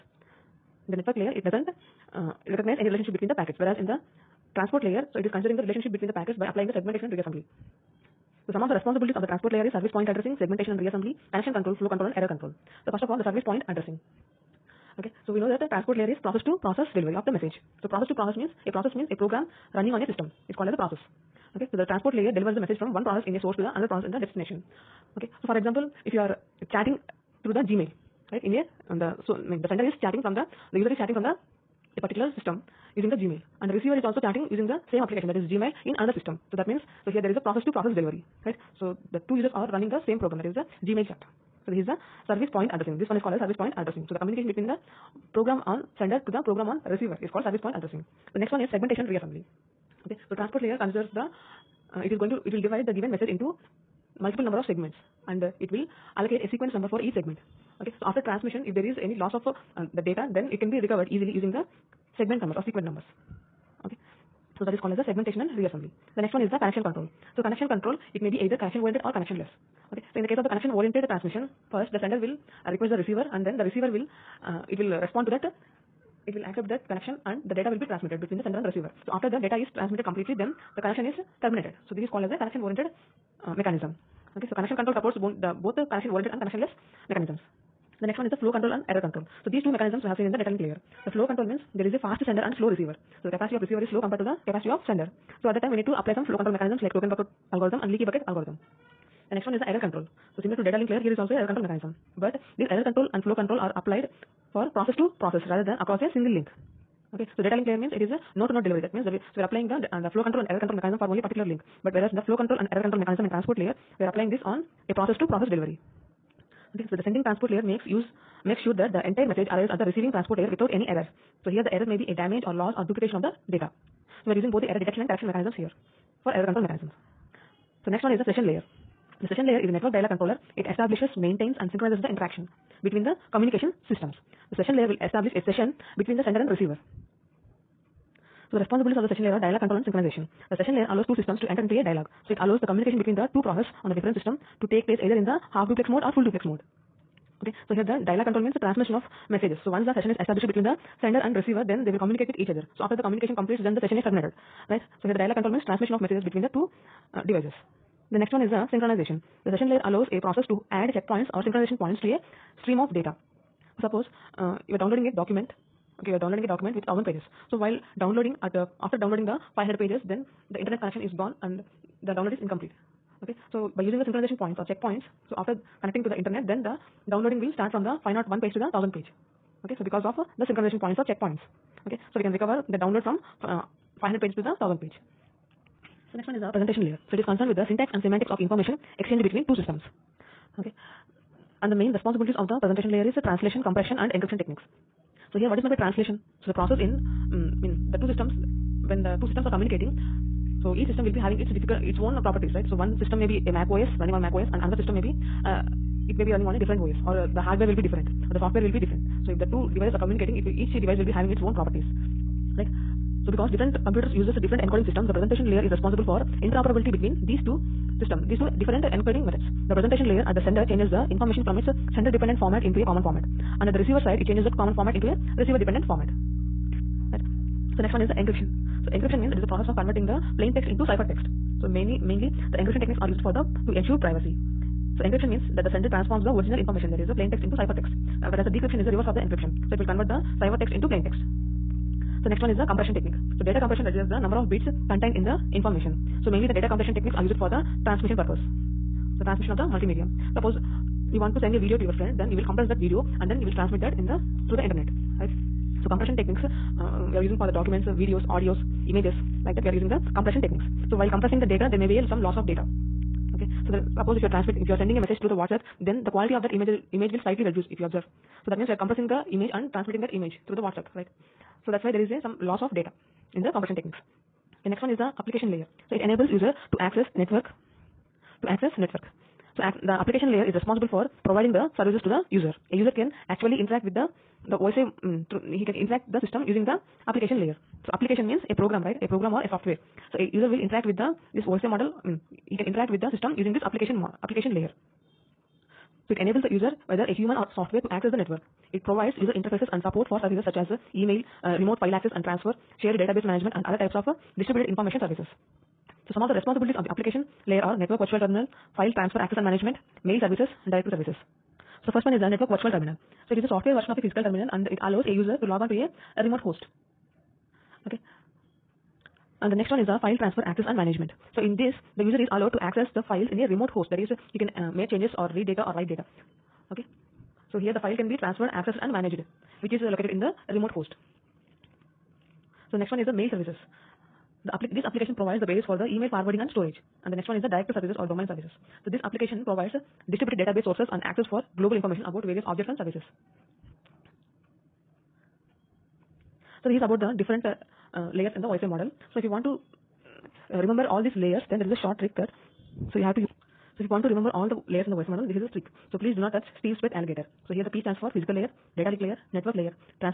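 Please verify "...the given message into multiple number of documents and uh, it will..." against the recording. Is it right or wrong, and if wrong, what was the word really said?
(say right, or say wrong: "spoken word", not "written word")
wrong: "segments", not "documents".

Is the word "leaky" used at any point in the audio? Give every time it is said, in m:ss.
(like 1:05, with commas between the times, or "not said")
1:37.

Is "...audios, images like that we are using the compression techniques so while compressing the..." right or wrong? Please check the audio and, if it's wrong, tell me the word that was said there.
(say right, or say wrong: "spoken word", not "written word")
right.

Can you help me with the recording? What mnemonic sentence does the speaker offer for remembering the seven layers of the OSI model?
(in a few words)
Please do not touch Steve's pet alligator.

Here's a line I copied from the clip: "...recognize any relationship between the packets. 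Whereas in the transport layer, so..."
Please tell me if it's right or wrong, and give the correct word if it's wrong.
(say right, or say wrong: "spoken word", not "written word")
right.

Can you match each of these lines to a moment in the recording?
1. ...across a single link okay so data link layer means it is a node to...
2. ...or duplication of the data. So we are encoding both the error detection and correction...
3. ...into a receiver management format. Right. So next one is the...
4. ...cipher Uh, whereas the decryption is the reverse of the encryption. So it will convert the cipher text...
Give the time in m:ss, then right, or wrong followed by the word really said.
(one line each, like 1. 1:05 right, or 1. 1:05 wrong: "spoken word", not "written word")
1. 1:45 right
2. 2:02 wrong: "using", not "encoding"
3. 3:44 wrong: "dependent", not "management"
4. 3:57 right.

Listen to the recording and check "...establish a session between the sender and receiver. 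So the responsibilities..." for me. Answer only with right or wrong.
right.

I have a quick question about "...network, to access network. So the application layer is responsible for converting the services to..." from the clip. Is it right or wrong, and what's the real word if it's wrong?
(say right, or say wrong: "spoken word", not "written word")
wrong: "providing", not "converting".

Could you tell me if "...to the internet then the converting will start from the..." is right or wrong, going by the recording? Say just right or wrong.
wrong.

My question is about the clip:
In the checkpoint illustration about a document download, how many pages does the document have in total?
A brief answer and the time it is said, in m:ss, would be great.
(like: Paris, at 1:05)
1000, at 2:46.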